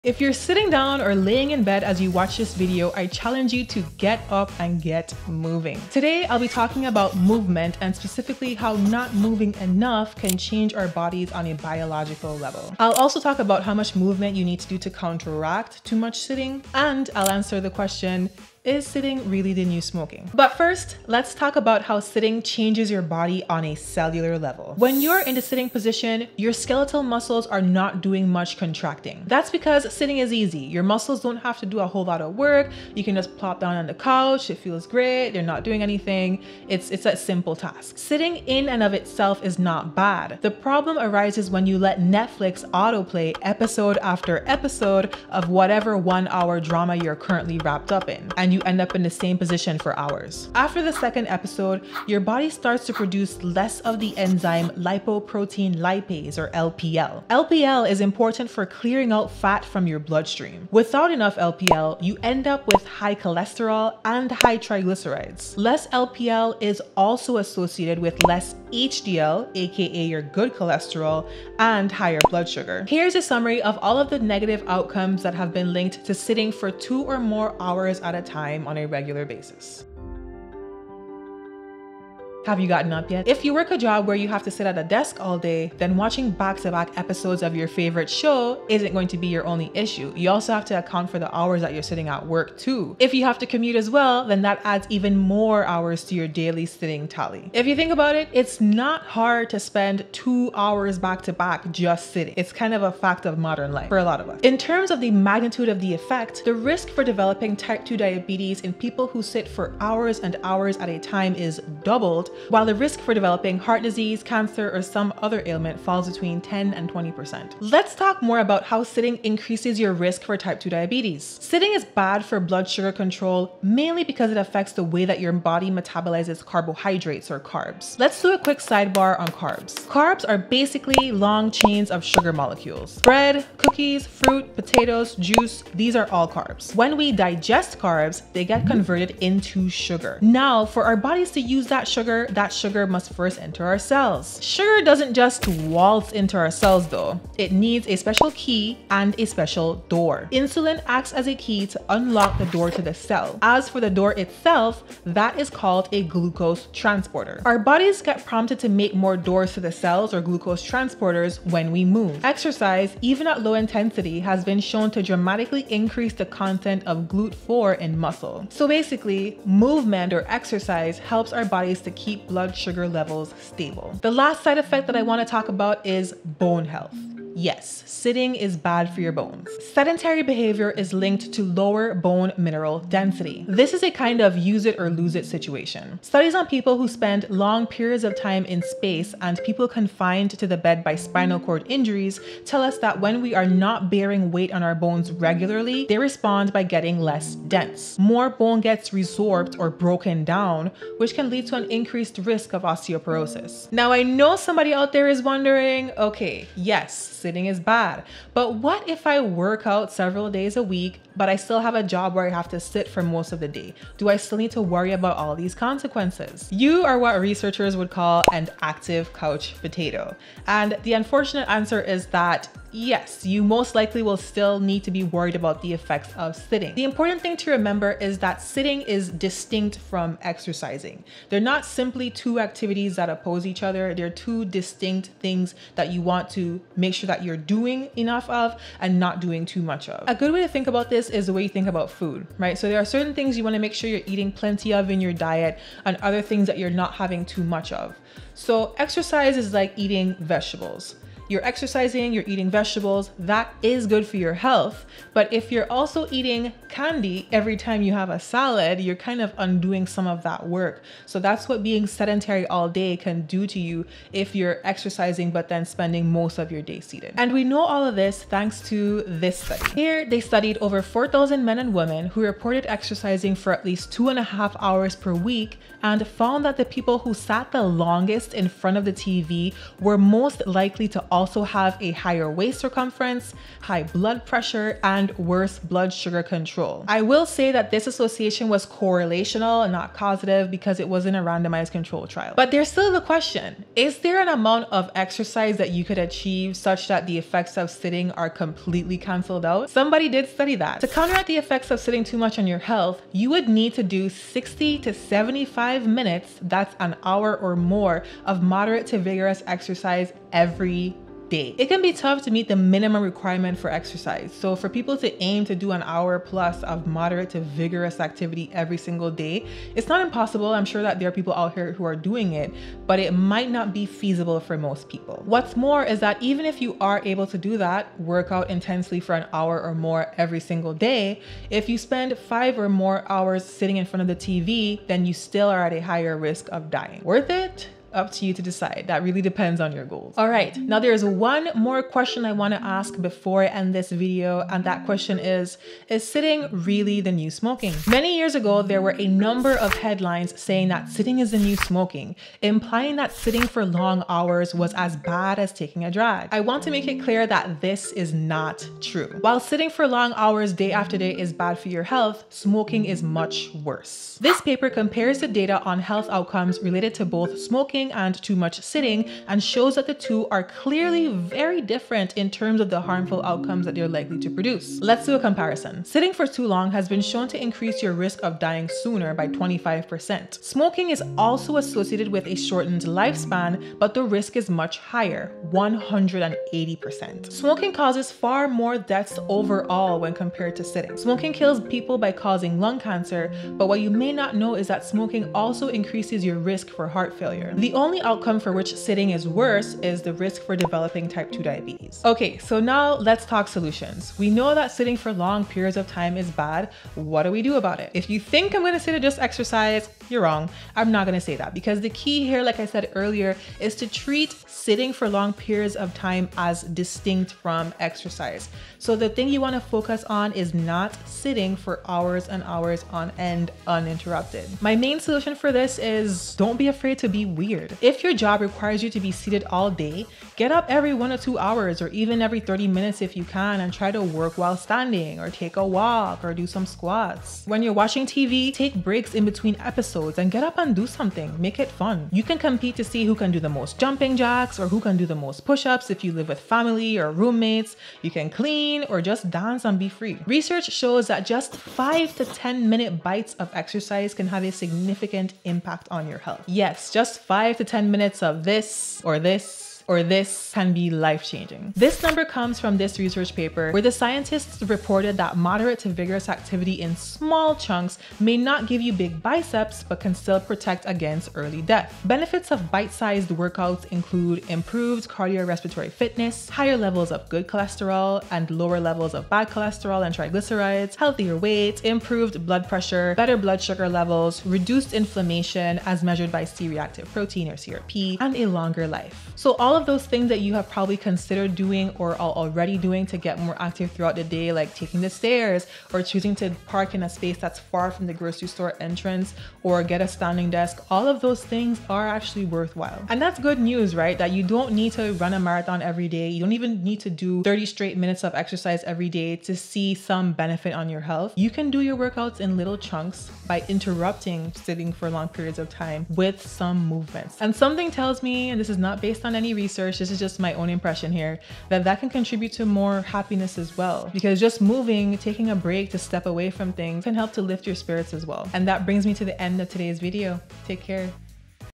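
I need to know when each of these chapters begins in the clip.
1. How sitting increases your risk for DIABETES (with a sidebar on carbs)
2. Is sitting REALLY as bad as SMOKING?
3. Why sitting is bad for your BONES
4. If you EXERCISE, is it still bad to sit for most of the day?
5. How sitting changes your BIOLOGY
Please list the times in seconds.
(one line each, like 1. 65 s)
1. 118 s
2. 340 s
3. 173 s
4. 204 s
5. 20 s.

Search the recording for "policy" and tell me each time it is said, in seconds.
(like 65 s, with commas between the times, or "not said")
not said.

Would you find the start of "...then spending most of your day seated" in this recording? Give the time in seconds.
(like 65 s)
265 s.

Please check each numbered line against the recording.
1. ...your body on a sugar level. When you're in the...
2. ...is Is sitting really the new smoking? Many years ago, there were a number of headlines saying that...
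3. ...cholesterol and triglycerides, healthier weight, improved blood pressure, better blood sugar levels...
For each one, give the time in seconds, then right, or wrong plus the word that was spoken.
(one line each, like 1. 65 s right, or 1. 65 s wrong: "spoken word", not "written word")
1. 22 s wrong: "cellular", not "sugar"
2. 345 s right
3. 479 s right.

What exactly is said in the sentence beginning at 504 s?
That you don't need to run a marathon every day.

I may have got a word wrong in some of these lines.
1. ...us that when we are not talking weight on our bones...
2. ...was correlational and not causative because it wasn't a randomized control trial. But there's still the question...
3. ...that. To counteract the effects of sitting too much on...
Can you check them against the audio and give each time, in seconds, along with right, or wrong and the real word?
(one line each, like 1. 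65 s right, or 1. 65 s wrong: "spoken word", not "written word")
1. 192 s wrong: "bearing", not "talking"
2. 288 s right
3. 300 s right.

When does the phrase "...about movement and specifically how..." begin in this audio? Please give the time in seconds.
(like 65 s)
6 s.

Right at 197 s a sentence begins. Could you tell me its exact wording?
More bone gets resorbed or broken down, which can lead to an increased risk of osteoporosis.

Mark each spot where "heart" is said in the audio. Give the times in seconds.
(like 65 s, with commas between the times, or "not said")
113 s, 396 s.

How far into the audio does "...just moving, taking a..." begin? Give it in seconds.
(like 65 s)
524 s.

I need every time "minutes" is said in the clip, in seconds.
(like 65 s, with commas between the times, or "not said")
305 s, 432 s, 452 s, 457 s, 507 s.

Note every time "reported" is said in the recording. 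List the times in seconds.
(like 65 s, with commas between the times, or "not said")
272 s, 464 s.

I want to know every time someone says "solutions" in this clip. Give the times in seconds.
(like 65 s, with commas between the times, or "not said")
403 s, 424 s.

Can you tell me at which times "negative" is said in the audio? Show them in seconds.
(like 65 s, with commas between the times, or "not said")
74 s.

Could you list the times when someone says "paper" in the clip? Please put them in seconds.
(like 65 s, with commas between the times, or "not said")
364 s, 463 s.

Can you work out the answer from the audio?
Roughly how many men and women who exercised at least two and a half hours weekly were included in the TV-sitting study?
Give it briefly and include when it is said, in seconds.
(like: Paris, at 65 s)
over 4,000, at 270 s.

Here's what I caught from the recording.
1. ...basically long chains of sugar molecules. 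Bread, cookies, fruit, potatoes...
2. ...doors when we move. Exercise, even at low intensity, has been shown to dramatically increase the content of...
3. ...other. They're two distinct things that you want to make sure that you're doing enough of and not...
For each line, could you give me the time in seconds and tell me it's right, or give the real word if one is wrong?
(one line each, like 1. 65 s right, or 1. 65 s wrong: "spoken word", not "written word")
1. 130 s right
2. 160 s wrong: "transporters", not "doors"
3. 233 s right.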